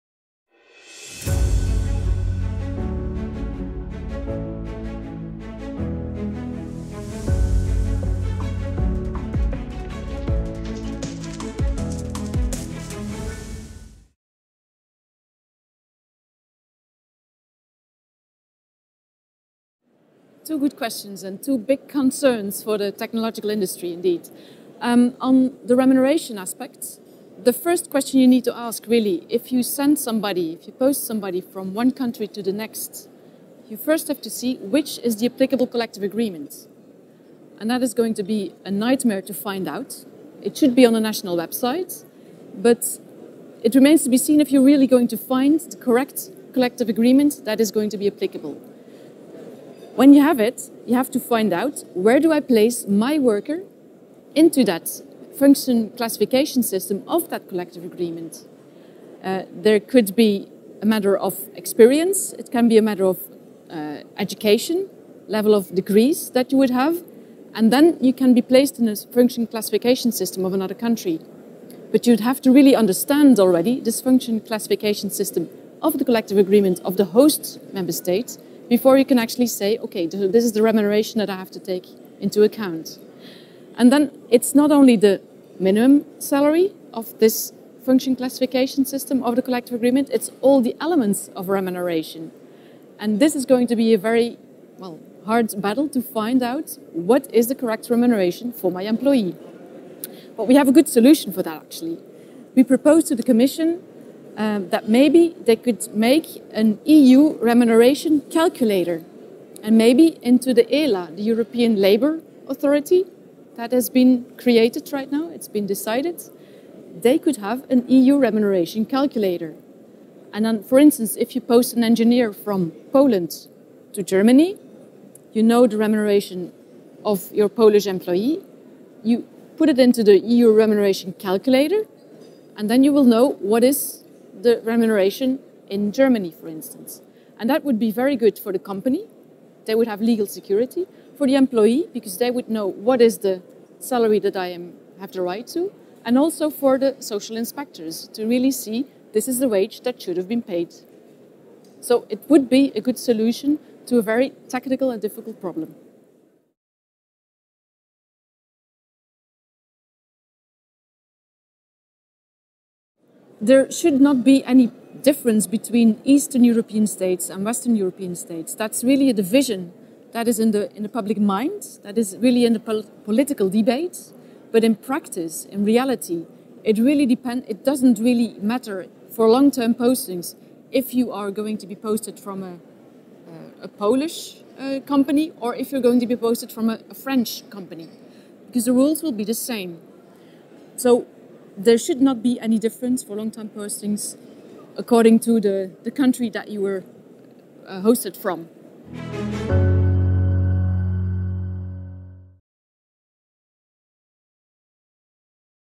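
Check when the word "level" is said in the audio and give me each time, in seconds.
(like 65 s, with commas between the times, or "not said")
65 s.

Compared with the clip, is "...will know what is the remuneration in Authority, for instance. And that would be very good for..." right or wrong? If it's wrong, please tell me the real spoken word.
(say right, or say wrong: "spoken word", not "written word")
wrong: "Germany", not "Authority".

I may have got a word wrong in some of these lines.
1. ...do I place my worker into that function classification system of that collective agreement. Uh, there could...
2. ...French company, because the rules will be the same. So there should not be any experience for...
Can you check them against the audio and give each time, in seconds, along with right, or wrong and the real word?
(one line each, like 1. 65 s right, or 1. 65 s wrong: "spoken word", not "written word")
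1. 52 s right
2. 186 s wrong: "difference", not "experience".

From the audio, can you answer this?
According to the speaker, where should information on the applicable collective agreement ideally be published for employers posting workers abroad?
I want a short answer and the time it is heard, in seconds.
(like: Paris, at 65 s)
a national website, at 40 s.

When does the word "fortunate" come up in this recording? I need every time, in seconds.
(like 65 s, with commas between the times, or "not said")
not said.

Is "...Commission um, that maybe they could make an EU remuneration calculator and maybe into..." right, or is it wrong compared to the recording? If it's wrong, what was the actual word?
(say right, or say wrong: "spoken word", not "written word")
right.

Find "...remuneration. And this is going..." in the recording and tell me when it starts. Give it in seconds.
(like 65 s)
91 s.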